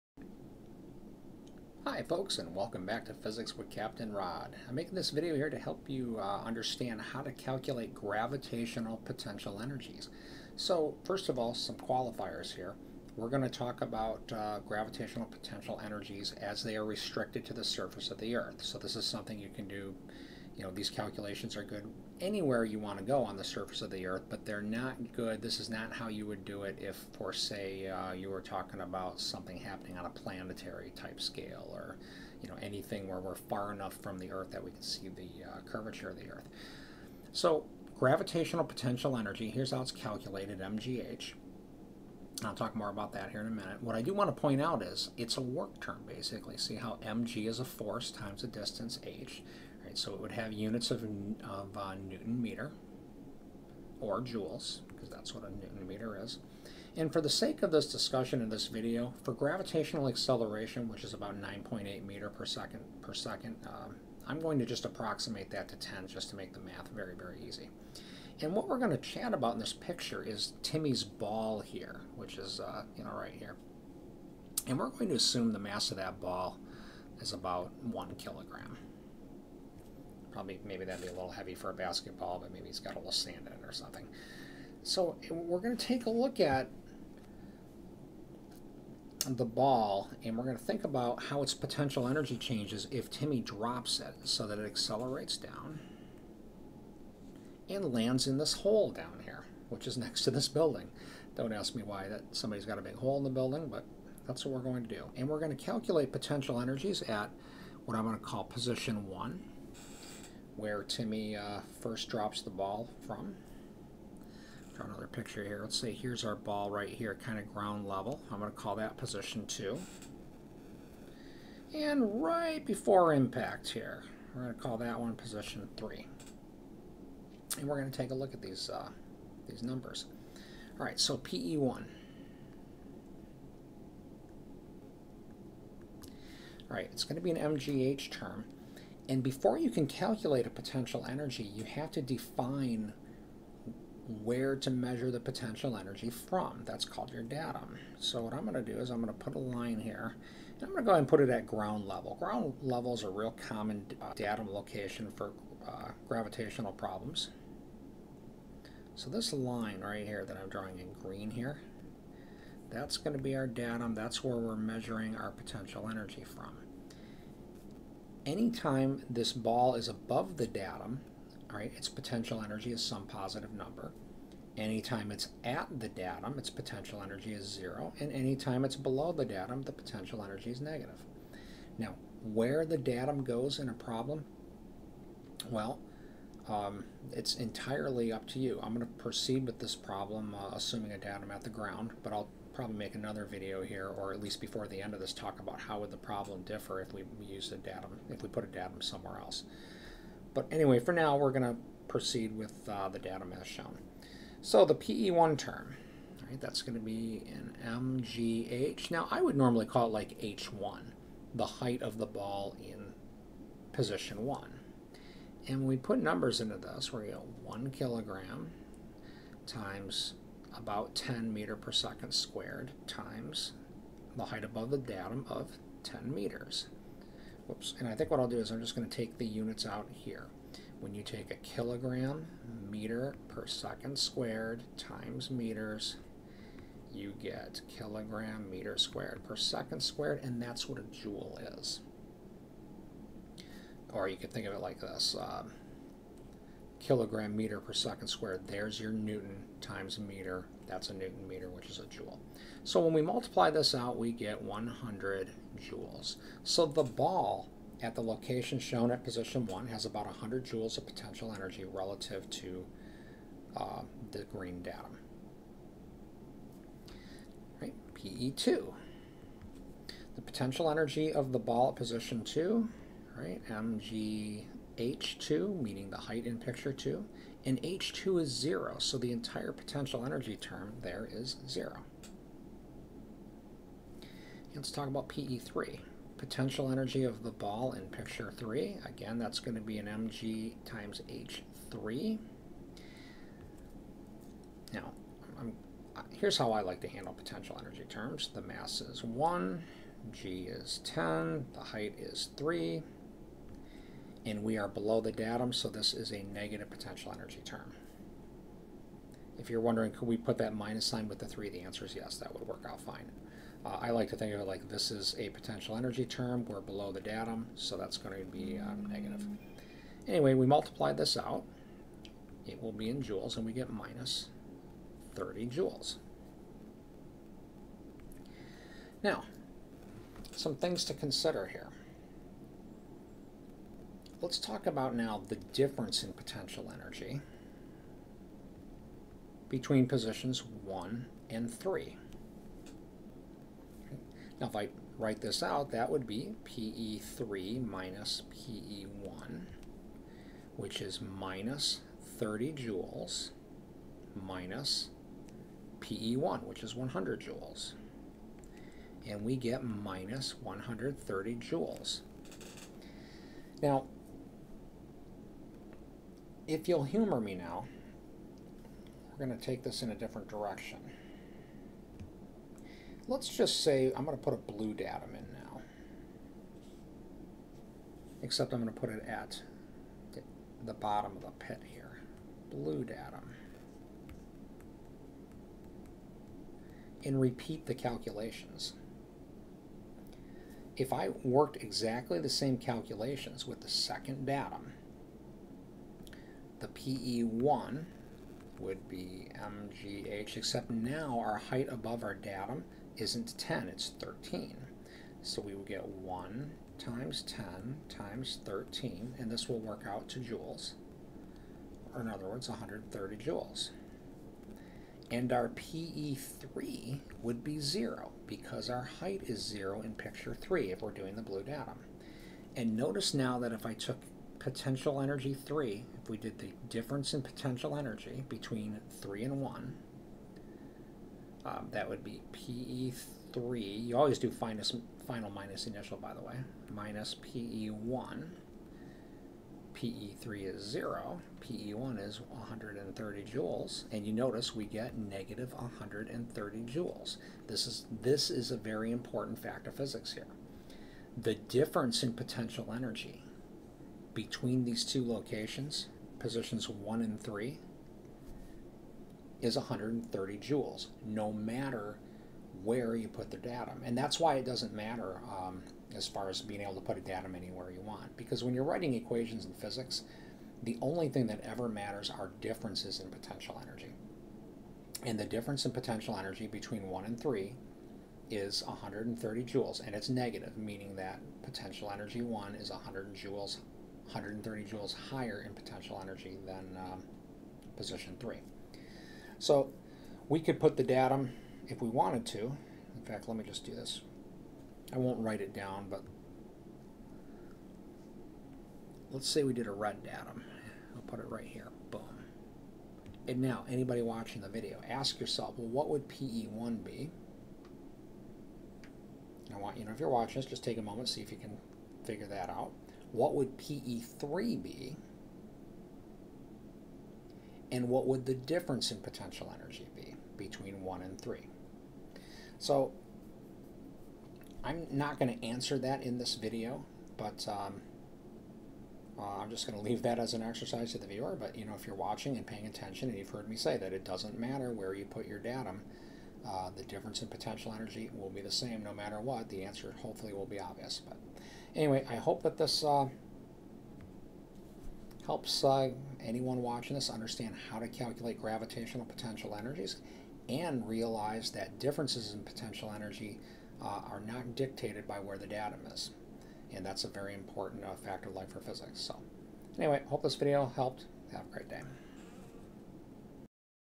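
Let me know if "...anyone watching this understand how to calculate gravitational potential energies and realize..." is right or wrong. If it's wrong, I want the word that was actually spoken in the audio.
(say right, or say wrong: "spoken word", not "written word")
right.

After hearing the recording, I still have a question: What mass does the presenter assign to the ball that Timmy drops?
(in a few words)
1 kilogram.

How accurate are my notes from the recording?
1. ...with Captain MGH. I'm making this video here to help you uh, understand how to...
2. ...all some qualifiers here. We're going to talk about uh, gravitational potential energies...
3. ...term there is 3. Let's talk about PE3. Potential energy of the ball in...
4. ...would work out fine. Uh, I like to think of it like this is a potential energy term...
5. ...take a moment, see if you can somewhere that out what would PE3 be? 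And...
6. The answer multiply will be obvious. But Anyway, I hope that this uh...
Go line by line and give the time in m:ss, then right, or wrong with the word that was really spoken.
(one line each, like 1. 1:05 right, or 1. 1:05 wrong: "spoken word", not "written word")
1. 0:03 wrong: "Rod", not "MGH"
2. 0:11 right
3. 4:40 wrong: "0", not "3"
4. 5:12 right
5. 8:30 wrong: "figure", not "somewhere"
6. 8:59 wrong: "hopefully", not "multiply".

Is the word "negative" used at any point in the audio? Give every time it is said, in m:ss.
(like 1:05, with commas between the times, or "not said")
3:00, 5:06, 5:18, 7:24, 8:00.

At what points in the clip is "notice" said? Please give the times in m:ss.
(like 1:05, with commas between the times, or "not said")
7:02, 7:24.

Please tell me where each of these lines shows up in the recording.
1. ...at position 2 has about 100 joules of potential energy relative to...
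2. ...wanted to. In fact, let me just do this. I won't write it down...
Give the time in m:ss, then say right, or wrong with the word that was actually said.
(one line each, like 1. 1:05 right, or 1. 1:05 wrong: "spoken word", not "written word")
1. 4:18 wrong: "1", not "2"
2. 8:11 right.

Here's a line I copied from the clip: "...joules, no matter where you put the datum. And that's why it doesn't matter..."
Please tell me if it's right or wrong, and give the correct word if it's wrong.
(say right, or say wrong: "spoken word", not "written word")
right.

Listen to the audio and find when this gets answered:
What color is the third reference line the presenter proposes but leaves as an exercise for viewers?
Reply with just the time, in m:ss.
8:19.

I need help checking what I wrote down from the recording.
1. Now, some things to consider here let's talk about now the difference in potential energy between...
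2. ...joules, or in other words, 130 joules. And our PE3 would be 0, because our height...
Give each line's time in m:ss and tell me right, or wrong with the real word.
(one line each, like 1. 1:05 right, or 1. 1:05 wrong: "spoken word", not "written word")
1. 5:29 right
2. 6:50 right.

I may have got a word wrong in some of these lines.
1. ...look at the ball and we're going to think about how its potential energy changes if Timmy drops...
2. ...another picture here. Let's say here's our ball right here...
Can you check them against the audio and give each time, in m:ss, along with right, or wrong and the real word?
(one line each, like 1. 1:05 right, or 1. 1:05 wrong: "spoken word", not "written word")
1. 1:26 right
2. 1:54 right.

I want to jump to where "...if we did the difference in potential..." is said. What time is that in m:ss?
7:06.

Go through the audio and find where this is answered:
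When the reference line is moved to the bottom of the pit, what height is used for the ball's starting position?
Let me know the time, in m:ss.
6:43.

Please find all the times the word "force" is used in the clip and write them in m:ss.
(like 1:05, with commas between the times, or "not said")
0:47.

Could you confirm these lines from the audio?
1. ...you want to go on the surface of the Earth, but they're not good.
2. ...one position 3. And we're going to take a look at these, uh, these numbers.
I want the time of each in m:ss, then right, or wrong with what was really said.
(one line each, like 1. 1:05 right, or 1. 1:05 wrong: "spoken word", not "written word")
1. 0:22 right
2. 2:04 right.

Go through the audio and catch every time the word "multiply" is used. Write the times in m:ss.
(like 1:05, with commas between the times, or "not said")
4:13, 5:20.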